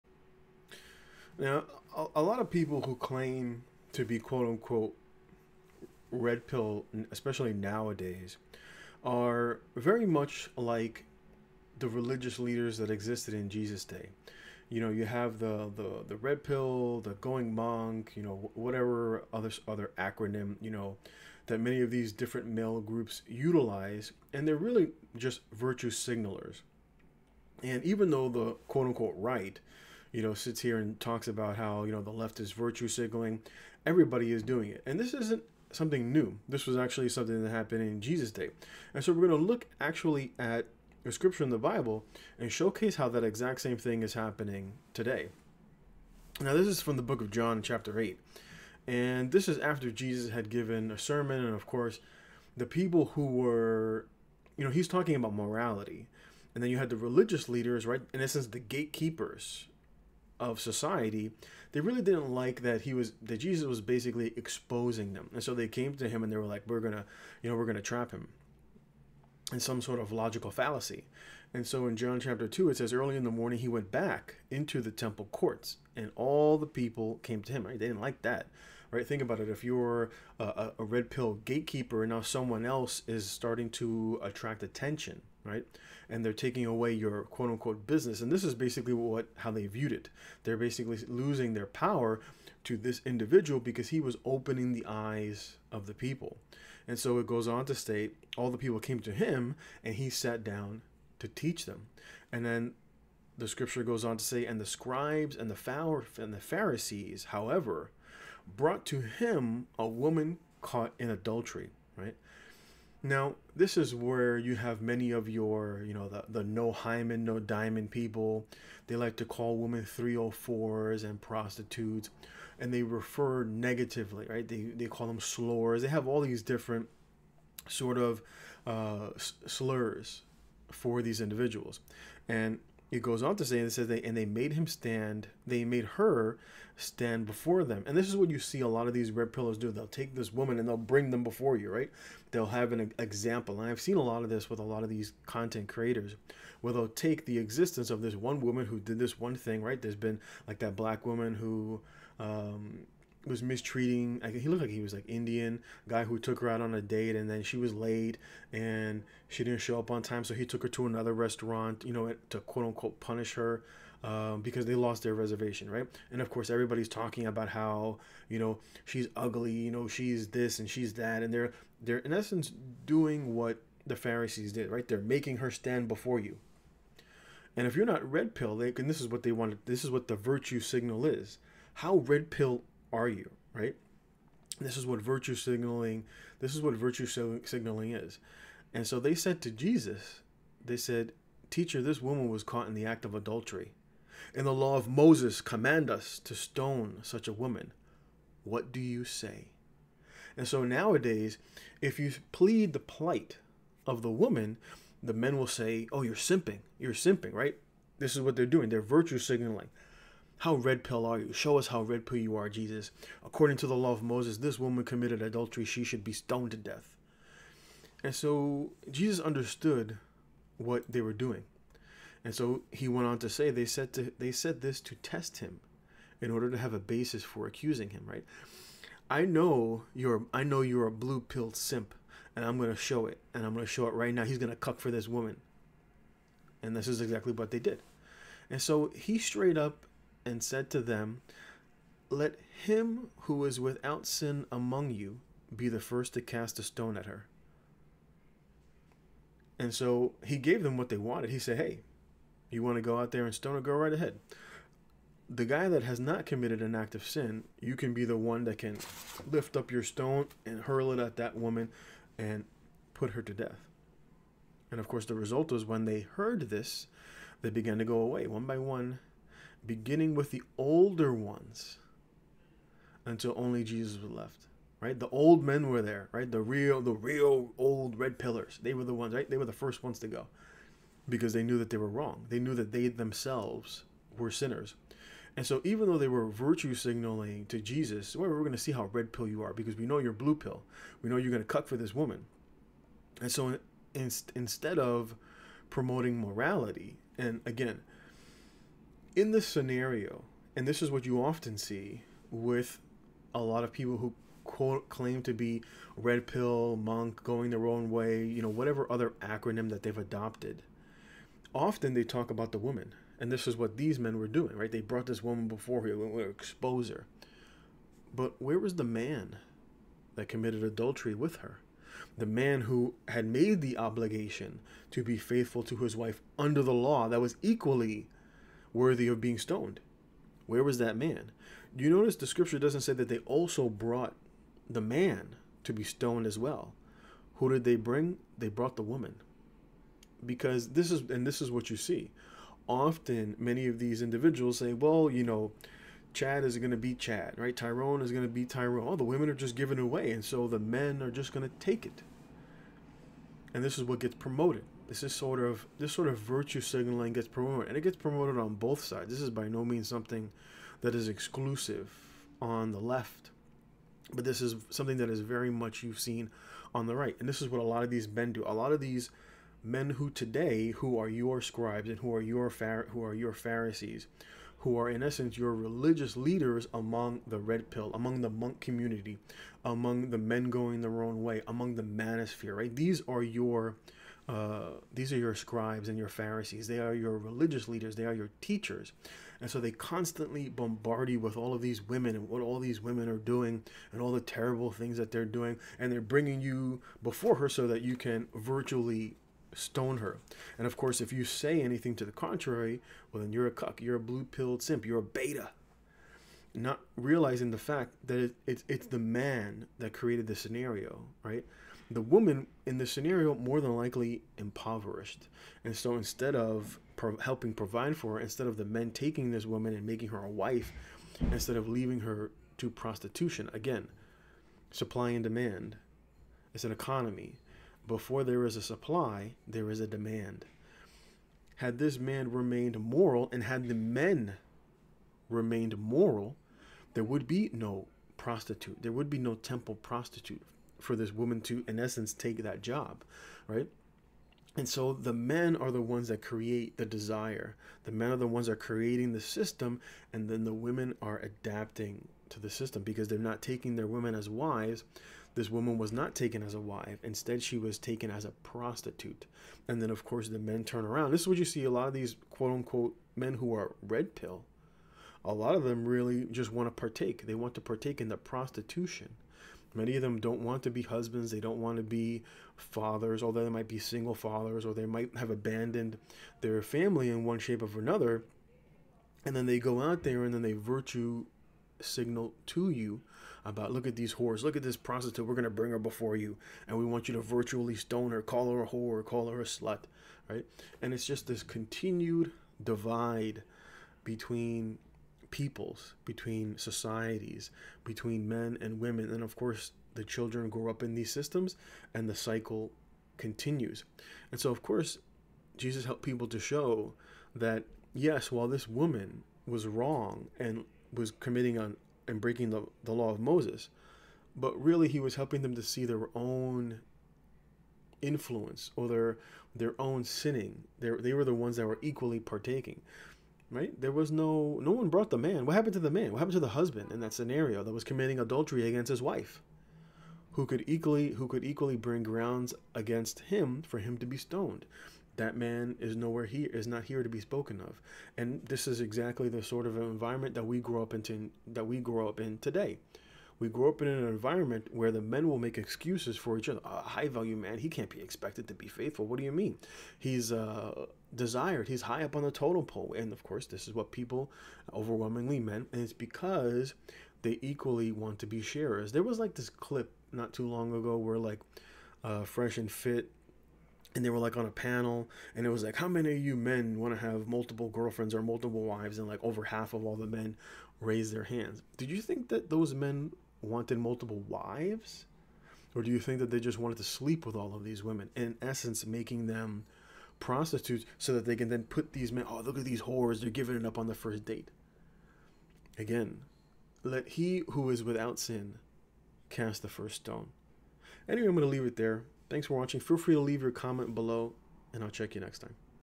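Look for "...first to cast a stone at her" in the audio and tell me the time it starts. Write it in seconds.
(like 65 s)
245 s.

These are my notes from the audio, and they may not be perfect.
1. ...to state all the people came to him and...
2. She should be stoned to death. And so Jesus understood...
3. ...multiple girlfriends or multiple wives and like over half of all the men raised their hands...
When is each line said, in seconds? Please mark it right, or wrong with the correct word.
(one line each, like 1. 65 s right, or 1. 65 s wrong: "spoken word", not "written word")
1. 97 s right
2. 215 s right
3. 567 s right.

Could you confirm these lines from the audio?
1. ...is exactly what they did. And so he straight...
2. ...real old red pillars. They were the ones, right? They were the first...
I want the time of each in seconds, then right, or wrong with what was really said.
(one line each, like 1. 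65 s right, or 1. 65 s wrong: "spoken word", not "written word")
1. 236 s right
2. 276 s right.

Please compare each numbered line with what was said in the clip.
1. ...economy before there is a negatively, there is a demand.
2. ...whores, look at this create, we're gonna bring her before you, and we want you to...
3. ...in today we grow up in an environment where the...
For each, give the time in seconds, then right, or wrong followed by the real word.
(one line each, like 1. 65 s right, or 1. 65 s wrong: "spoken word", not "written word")
1. 426 s wrong: "supply", not "negatively"
2. 484 s wrong: "prostitute", not "create"
3. 542 s right.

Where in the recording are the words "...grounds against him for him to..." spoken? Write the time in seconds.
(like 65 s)
532 s.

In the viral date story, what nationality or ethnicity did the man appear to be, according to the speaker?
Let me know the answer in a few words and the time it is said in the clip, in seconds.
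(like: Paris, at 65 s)
Indian, at 155 s.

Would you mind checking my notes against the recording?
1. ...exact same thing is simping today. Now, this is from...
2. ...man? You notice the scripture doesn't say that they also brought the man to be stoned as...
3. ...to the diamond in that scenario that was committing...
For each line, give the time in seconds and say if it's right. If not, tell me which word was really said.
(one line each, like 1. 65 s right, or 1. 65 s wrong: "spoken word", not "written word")
1. 43 s wrong: "happening", not "simping"
2. 330 s right
3. 526 s wrong: "husband", not "diamond".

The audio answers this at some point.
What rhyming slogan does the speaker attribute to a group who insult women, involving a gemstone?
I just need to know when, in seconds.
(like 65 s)
116 s.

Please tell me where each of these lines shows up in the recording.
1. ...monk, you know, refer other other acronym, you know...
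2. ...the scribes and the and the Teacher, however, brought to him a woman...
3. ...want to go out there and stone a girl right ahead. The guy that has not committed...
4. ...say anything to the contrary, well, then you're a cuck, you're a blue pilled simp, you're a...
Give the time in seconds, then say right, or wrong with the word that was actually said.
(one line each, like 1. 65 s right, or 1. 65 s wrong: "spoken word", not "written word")
1. 17 s wrong: "whatever", not "refer"
2. 104 s wrong: "Pharisees", not "Teacher"
3. 252 s right
4. 401 s right.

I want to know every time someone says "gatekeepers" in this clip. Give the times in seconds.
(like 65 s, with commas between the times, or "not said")
58 s, 81 s.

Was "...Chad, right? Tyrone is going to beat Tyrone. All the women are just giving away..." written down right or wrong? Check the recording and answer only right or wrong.
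right.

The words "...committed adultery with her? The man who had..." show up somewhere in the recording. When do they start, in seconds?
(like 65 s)
320 s.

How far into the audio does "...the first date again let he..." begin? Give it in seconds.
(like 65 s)
583 s.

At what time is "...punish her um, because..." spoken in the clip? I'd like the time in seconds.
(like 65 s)
162 s.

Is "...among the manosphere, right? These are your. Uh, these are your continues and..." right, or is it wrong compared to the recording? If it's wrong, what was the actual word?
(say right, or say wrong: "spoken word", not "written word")
wrong: "scribes", not "continues".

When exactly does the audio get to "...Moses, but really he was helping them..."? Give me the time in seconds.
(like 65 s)
513 s.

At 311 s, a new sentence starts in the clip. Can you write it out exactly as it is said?
Often they talk about the woman, and this is what these men were doing, right?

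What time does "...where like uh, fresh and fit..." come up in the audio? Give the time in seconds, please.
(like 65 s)
560 s.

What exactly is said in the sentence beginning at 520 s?
They they were the ones that were equally partaking.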